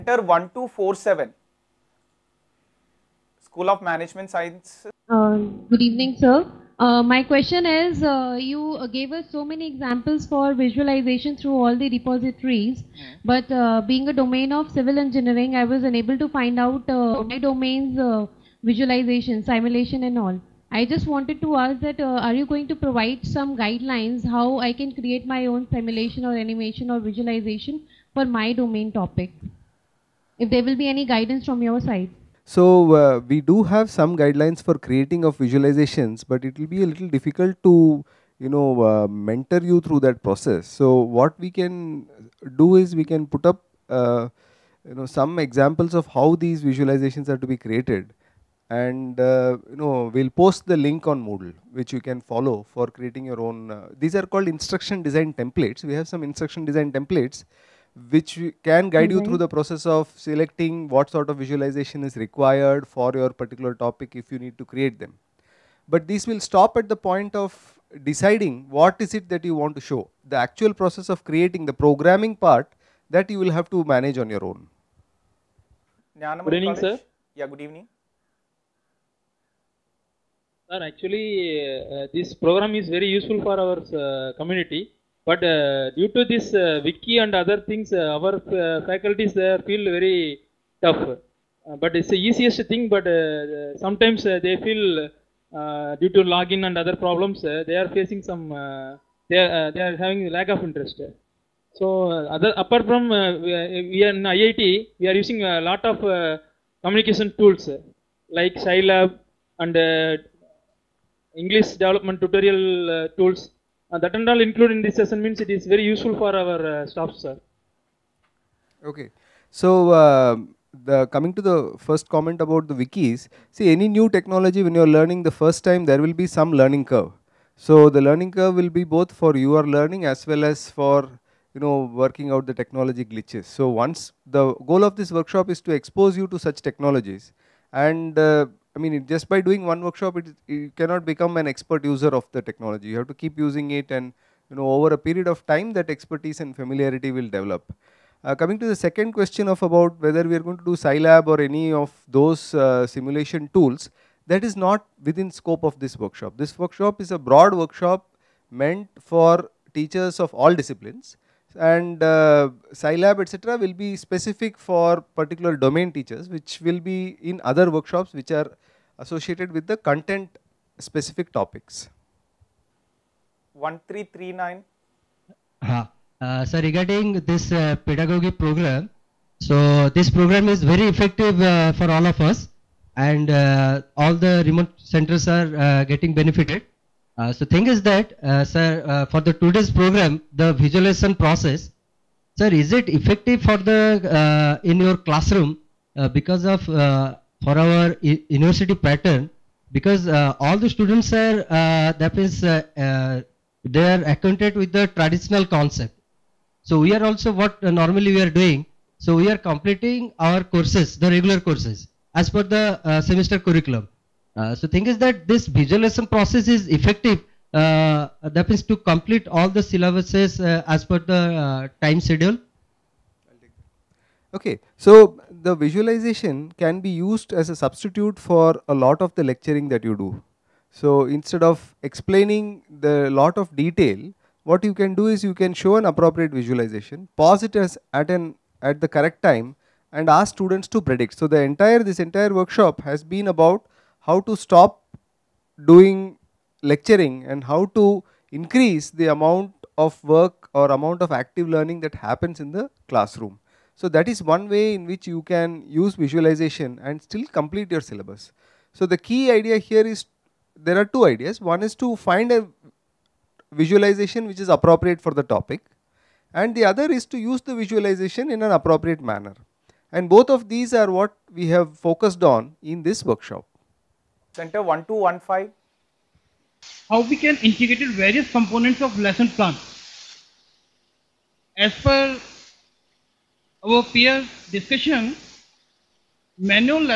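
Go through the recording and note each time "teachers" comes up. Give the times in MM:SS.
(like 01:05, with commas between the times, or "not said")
02:39, 02:45.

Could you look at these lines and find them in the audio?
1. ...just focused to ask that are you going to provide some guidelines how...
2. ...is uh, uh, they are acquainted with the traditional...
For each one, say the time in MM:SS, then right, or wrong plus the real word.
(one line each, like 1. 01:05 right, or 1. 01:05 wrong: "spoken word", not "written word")
1. 00:20 wrong: "wanted", not "focused"
2. 03:22 right.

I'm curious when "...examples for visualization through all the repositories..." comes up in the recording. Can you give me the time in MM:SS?
00:09.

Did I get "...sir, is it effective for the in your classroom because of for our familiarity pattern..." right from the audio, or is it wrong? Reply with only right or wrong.
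wrong.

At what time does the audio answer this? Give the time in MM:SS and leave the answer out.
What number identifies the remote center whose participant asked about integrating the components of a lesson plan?
04:34.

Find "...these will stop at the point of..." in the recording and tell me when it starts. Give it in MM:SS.
01:06.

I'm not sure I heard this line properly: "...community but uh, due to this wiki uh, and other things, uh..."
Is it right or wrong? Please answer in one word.
right.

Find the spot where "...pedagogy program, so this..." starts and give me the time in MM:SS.
02:57.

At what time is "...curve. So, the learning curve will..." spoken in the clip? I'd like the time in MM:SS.
02:06.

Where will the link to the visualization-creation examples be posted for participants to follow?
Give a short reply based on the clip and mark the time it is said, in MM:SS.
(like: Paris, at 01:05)
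Moodle, at 00:51.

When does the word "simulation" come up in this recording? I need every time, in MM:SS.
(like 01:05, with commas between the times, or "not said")
00:19, 00:25, 02:32.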